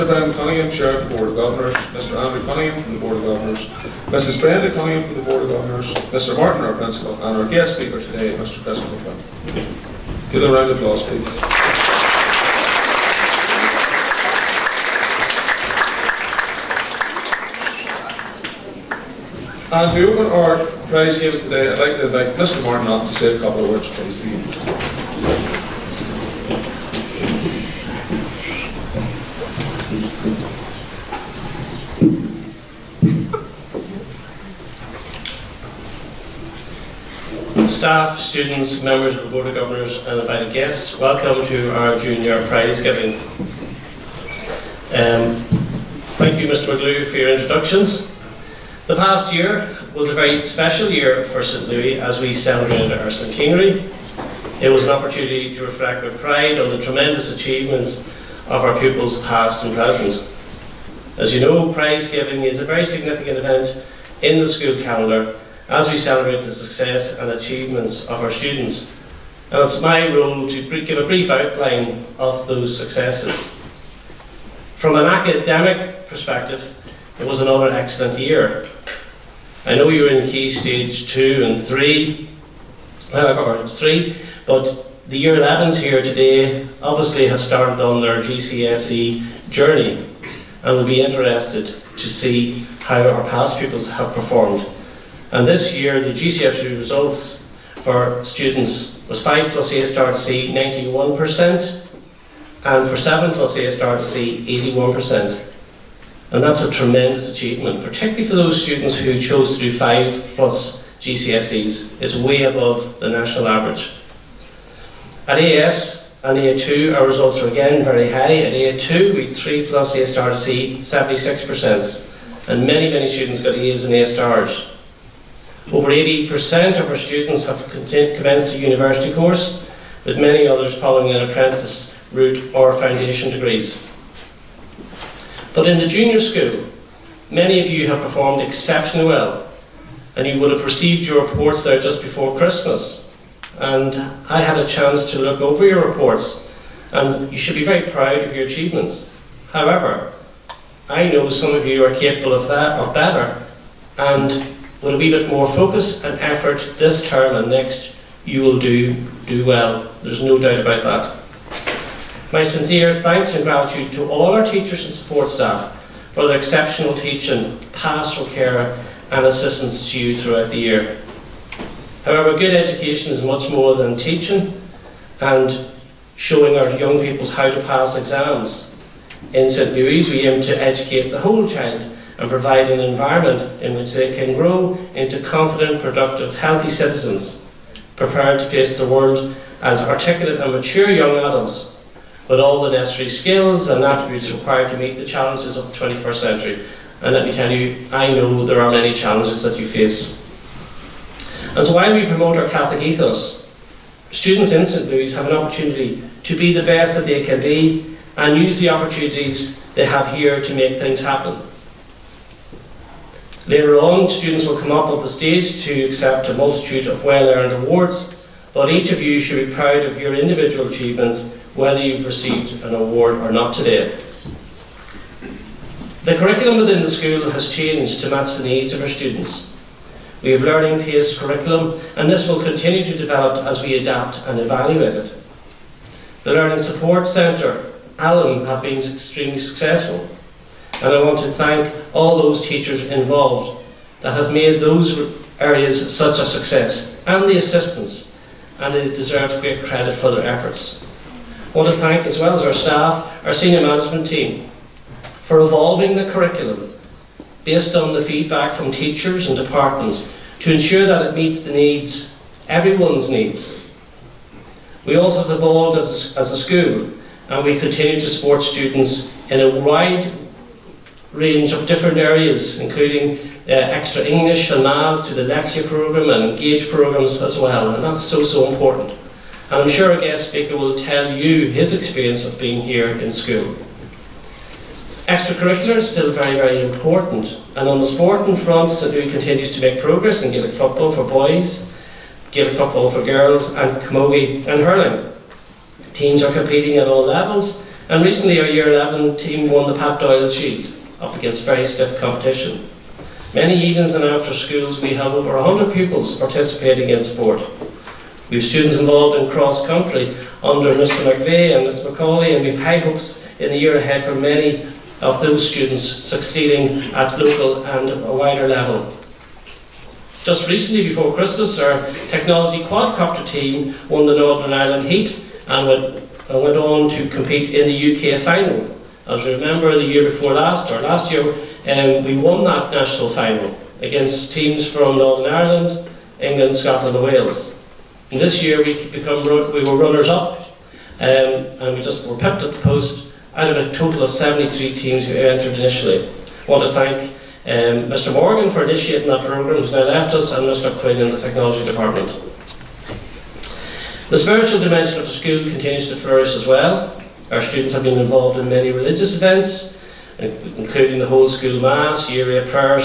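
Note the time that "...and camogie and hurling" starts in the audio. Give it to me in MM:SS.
04:53.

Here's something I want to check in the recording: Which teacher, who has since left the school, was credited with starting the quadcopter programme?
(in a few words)
Mr Morgan.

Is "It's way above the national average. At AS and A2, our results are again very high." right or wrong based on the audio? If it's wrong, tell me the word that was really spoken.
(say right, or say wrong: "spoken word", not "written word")
right.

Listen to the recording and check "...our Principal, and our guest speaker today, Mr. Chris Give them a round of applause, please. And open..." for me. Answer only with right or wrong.
right.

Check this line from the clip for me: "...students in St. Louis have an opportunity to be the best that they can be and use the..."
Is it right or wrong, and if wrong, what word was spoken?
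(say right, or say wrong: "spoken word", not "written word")
right.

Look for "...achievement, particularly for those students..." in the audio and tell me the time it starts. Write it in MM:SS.
01:47.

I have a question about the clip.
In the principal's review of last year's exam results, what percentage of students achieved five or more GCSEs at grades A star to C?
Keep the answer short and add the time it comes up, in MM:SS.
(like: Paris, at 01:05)
91%, at 01:40.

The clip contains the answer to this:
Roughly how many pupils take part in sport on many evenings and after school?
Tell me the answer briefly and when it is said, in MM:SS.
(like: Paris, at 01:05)
Over 100, at 05:05.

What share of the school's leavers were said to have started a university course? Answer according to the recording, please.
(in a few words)
Over 80%.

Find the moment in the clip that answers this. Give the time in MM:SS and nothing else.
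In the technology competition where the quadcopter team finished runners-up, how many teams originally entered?
05:44.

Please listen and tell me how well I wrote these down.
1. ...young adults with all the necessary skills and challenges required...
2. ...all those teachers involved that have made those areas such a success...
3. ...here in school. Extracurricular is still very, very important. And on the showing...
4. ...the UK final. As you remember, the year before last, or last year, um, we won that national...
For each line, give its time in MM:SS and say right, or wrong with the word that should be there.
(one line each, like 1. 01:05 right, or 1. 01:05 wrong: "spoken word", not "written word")
1. 03:10 wrong: "attributes", not "challenges"
2. 04:01 right
3. 04:42 wrong: "sporting", not "showing"
4. 05:27 right.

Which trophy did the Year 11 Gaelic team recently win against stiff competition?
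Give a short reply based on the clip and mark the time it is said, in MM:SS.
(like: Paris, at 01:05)
Pat Doyle Shield, at 04:59.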